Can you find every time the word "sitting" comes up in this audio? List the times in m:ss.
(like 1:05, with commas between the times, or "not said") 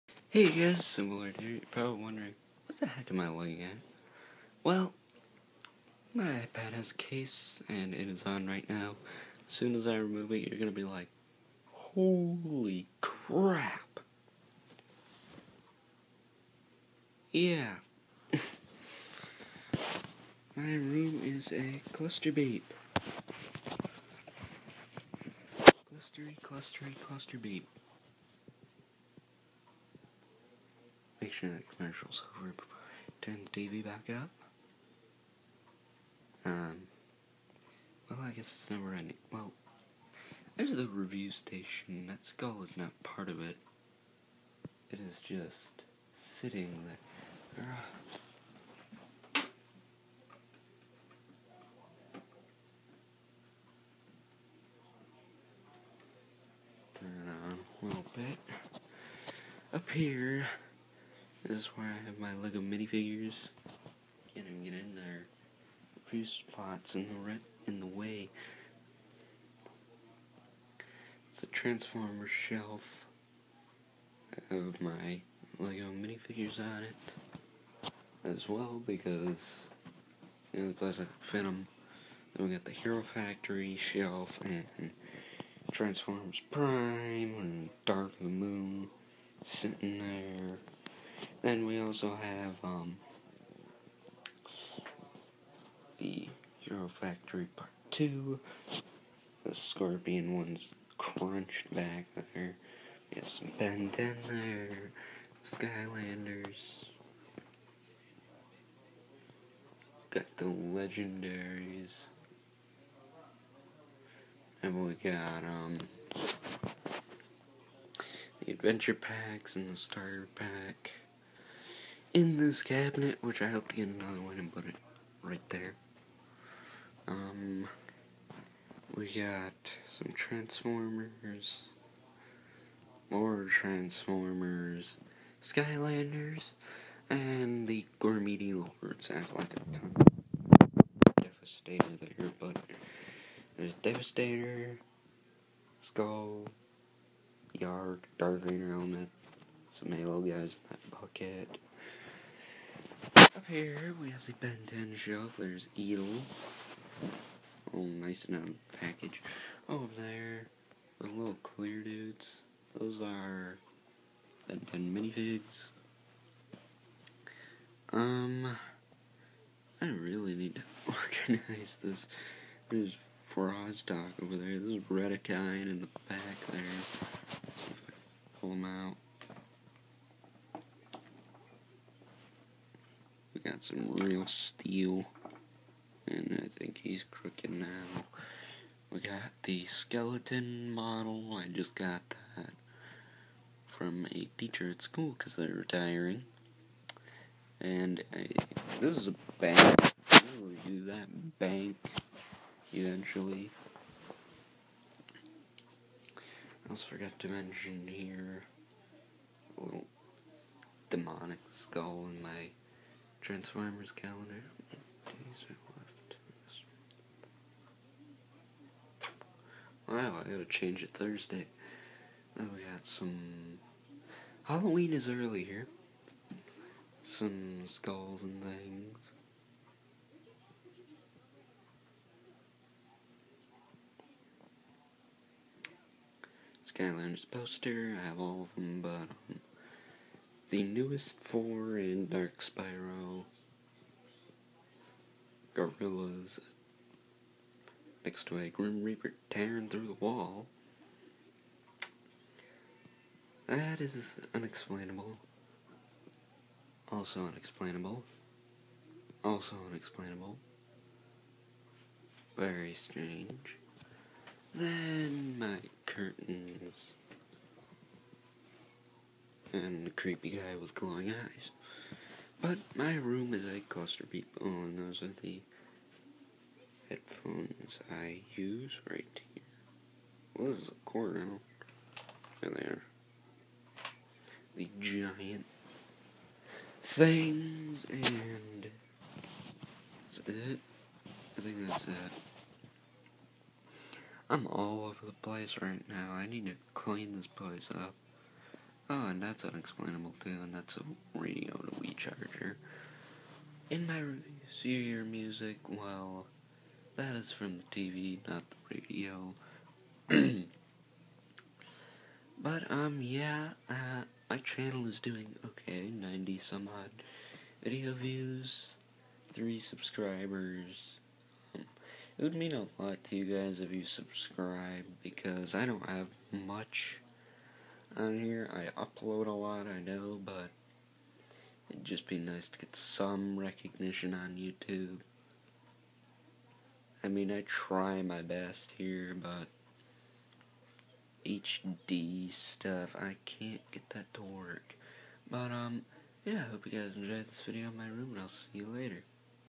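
0:46, 1:29.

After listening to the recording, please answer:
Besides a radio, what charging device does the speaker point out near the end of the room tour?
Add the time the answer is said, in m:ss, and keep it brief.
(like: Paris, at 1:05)
Wii charger, at 5:01.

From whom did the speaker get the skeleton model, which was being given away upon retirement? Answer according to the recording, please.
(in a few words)
a teacher.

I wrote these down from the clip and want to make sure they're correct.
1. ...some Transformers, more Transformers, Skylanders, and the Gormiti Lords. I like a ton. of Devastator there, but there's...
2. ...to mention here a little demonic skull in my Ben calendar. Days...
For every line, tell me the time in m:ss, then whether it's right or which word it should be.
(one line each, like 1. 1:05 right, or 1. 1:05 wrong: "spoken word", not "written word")
1. 2:09 right
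2. 3:27 wrong: "Transformers", not "Ben".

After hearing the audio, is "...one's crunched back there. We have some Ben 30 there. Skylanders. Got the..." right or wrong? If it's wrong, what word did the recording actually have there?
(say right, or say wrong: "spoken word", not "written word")
wrong: "10", not "30".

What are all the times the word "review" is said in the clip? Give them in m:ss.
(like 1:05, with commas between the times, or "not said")
0:40, 5:03.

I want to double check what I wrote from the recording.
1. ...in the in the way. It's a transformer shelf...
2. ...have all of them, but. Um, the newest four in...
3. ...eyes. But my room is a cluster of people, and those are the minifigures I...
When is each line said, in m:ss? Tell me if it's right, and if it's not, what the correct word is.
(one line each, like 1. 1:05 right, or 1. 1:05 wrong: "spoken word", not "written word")
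1. 1:06 right
2. 3:58 right
3. 4:31 wrong: "headphones", not "minifigures".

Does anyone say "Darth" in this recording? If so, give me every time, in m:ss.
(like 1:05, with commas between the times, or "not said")
2:28.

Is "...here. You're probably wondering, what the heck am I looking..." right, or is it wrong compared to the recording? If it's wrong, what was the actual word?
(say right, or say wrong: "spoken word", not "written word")
right.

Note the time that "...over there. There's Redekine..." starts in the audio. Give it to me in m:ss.
2:54.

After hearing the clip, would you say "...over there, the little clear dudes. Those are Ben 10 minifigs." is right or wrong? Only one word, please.
right.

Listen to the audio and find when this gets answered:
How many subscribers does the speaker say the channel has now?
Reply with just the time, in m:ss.
5:19.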